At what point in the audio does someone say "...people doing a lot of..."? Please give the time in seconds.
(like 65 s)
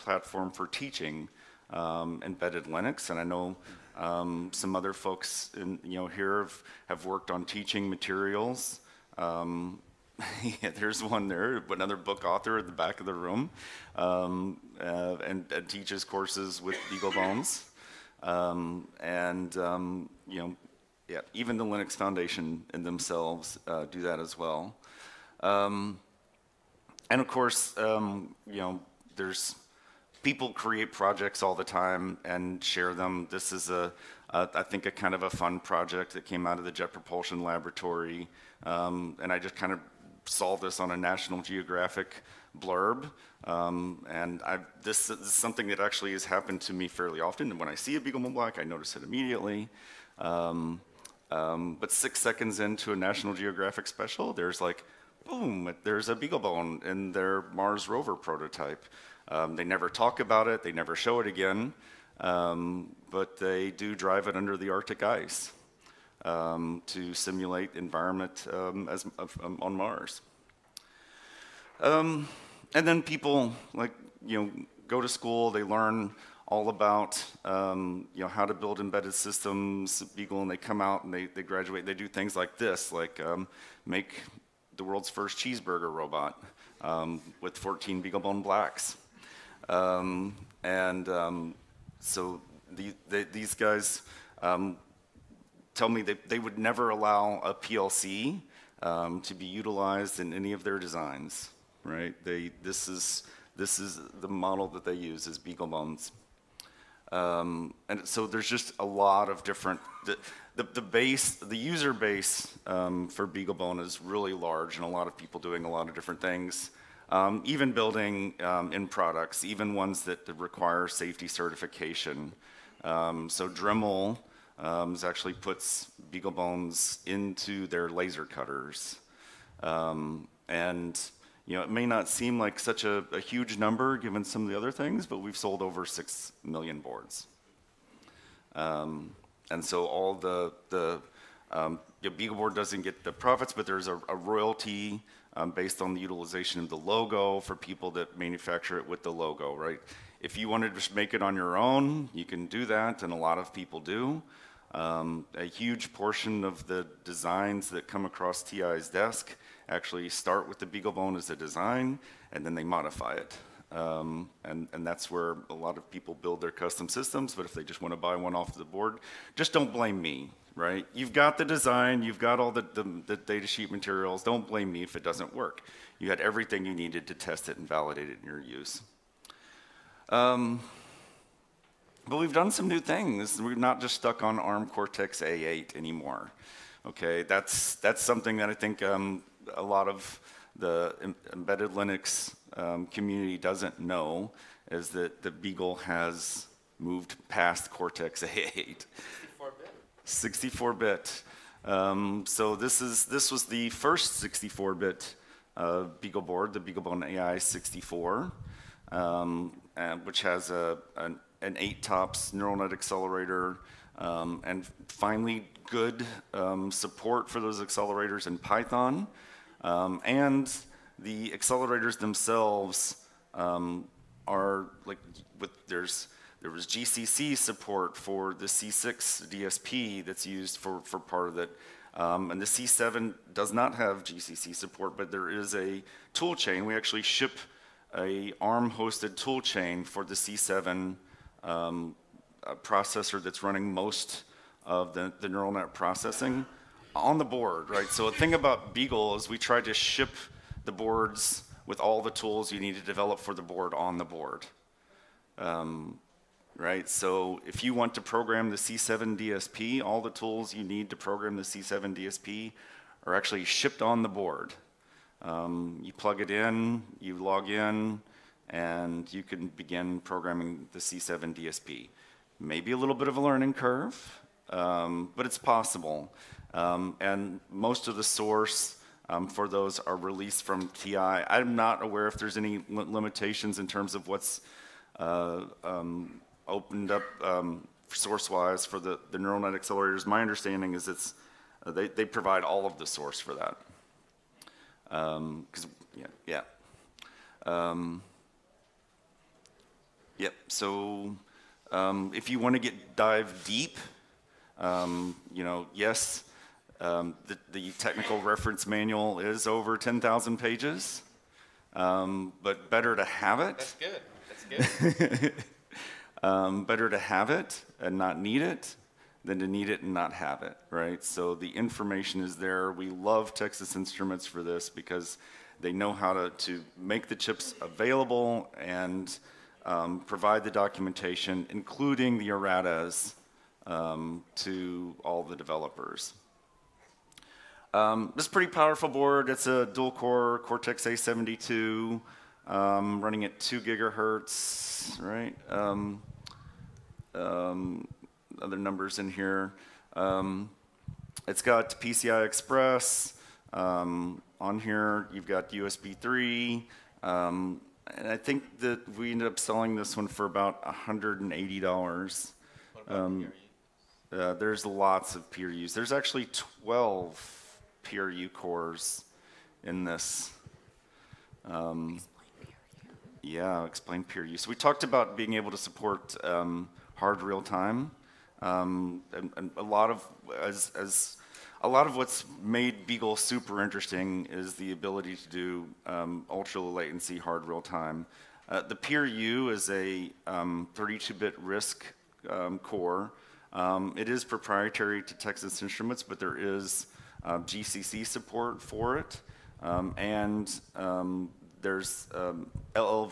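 115 s.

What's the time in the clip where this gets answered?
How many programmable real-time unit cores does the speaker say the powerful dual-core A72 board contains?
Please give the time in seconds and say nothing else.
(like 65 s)
366 s.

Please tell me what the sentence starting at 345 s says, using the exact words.
Um, um, other numbers in here.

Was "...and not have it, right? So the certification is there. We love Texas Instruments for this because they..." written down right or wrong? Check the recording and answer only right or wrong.
wrong.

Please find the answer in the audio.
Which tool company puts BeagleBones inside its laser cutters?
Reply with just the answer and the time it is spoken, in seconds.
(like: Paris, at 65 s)
Dremel, at 123 s.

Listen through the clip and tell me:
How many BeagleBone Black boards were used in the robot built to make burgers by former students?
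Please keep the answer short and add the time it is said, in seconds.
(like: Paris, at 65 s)
14, at 87 s.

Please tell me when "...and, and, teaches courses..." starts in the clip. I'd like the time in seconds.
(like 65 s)
15 s.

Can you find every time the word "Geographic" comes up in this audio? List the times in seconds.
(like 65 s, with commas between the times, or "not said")
41 s, 53 s.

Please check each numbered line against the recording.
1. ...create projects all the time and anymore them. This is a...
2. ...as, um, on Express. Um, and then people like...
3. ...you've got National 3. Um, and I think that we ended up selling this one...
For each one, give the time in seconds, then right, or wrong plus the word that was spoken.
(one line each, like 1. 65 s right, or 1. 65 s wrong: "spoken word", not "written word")
1. 30 s wrong: "share", not "anymore"
2. 68 s wrong: "Mars", not "Express"
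3. 355 s wrong: "USB", not "National".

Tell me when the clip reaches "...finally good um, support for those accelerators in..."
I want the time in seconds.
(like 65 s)
214 s.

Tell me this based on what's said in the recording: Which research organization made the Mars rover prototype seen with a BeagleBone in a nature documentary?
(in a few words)
Jet Propulsion Laboratory.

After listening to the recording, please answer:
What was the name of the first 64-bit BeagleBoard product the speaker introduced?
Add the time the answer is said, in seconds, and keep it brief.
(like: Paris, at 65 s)
BeagleBone AI 64, at 206 s.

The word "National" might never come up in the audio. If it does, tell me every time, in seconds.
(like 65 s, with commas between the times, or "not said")
40 s, 52 s.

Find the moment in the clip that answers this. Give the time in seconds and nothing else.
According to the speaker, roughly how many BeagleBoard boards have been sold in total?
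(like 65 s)
135 s.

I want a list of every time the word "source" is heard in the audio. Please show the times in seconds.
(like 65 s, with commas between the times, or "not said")
278 s, 292 s.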